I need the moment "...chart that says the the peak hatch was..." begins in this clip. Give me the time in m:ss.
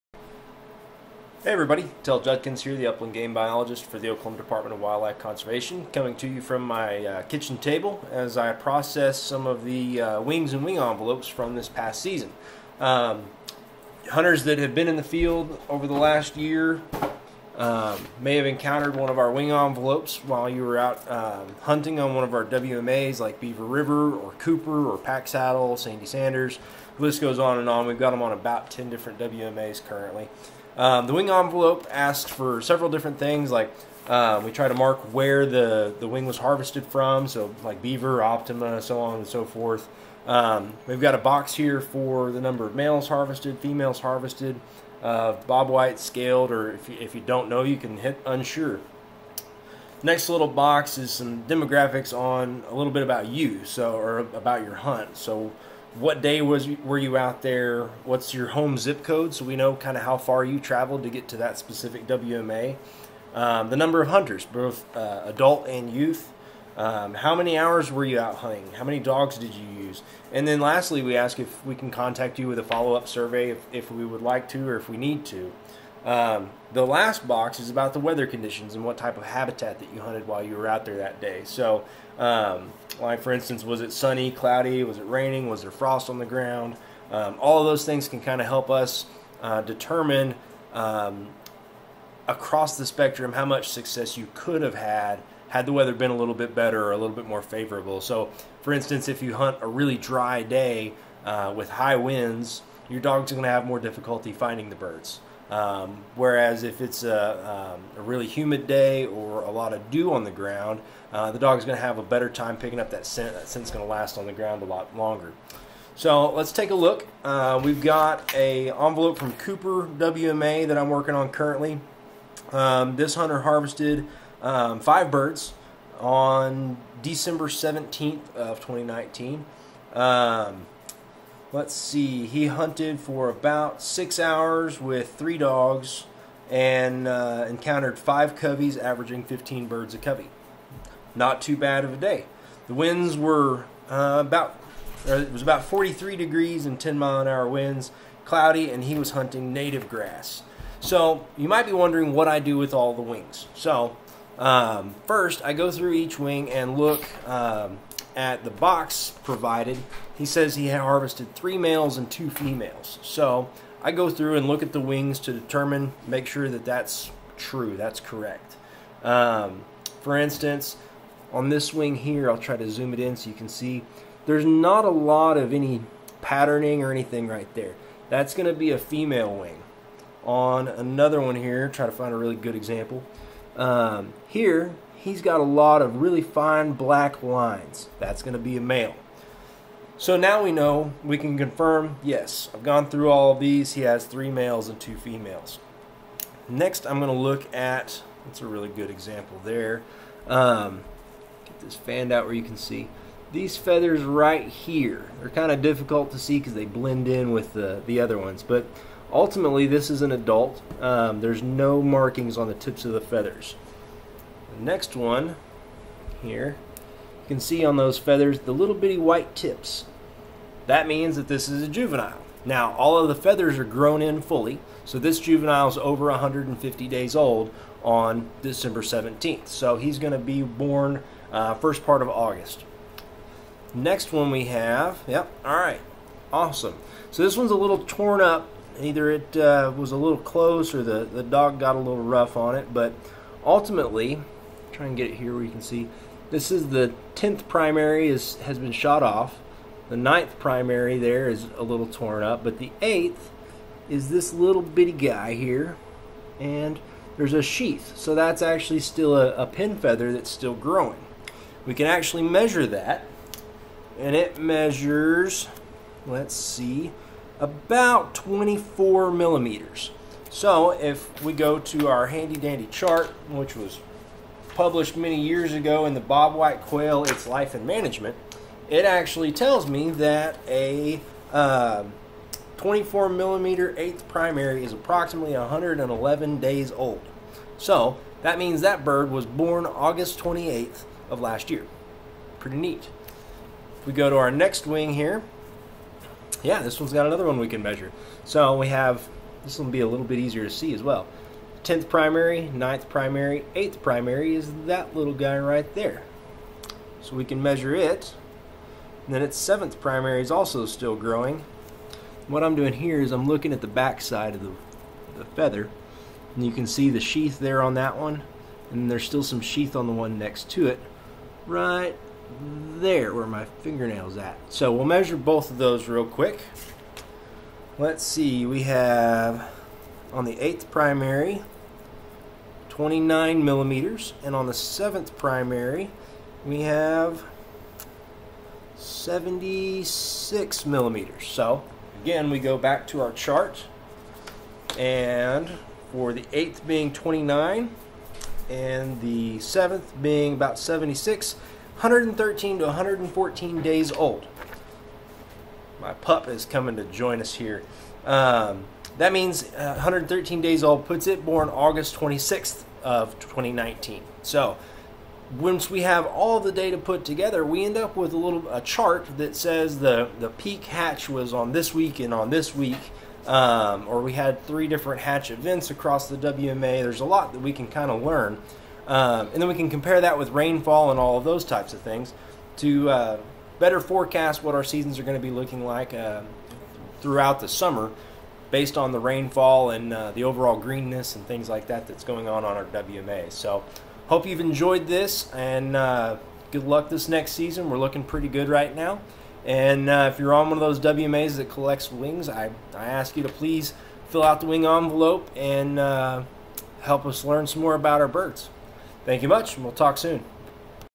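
6:08.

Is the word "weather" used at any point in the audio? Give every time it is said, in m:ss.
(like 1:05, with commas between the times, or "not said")
1:17, 1:35.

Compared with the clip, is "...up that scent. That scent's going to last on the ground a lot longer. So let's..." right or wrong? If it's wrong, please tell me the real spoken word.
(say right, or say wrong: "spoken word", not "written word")
right.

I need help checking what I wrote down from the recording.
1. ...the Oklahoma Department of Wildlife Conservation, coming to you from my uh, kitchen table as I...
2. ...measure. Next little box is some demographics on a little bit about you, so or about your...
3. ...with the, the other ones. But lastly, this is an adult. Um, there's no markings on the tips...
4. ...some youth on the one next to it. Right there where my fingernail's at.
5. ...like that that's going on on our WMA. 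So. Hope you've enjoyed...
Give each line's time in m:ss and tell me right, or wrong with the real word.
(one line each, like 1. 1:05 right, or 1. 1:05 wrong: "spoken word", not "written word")
1. 0:03 right
2. 0:48 wrong: "unsure", not "measure"
3. 3:27 wrong: "ultimately", not "lastly"
4. 5:19 wrong: "sheath", not "youth"
5. 6:31 right.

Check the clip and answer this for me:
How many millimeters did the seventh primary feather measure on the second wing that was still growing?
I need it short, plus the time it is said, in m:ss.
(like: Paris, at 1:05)
76, at 5:38.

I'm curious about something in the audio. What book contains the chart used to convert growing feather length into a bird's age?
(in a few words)
Bobwhite Quail, Its Life and Management.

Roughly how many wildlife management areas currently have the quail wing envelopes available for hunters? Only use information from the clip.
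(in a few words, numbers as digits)
10.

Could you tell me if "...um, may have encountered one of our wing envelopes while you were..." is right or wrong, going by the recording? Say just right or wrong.
right.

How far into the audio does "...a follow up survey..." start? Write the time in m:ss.
1:12.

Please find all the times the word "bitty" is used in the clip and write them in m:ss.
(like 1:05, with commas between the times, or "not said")
3:38, 4:14.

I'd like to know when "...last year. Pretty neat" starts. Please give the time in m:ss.
4:51.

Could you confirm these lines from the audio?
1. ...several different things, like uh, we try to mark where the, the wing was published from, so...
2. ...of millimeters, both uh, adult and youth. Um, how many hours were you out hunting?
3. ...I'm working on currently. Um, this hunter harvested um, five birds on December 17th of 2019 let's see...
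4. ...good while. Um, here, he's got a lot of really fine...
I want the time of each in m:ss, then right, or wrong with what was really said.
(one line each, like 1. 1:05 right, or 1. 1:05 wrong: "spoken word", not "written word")
1. 0:32 wrong: "harvested", not "published"
2. 1:04 wrong: "hunters", not "millimeters"
3. 2:00 right
4. 3:02 wrong: "example", not "while".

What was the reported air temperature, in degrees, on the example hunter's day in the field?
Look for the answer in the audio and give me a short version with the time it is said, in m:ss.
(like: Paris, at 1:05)
43, at 2:25.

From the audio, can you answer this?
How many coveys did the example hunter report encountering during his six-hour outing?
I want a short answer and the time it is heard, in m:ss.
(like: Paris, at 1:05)
5, at 2:17.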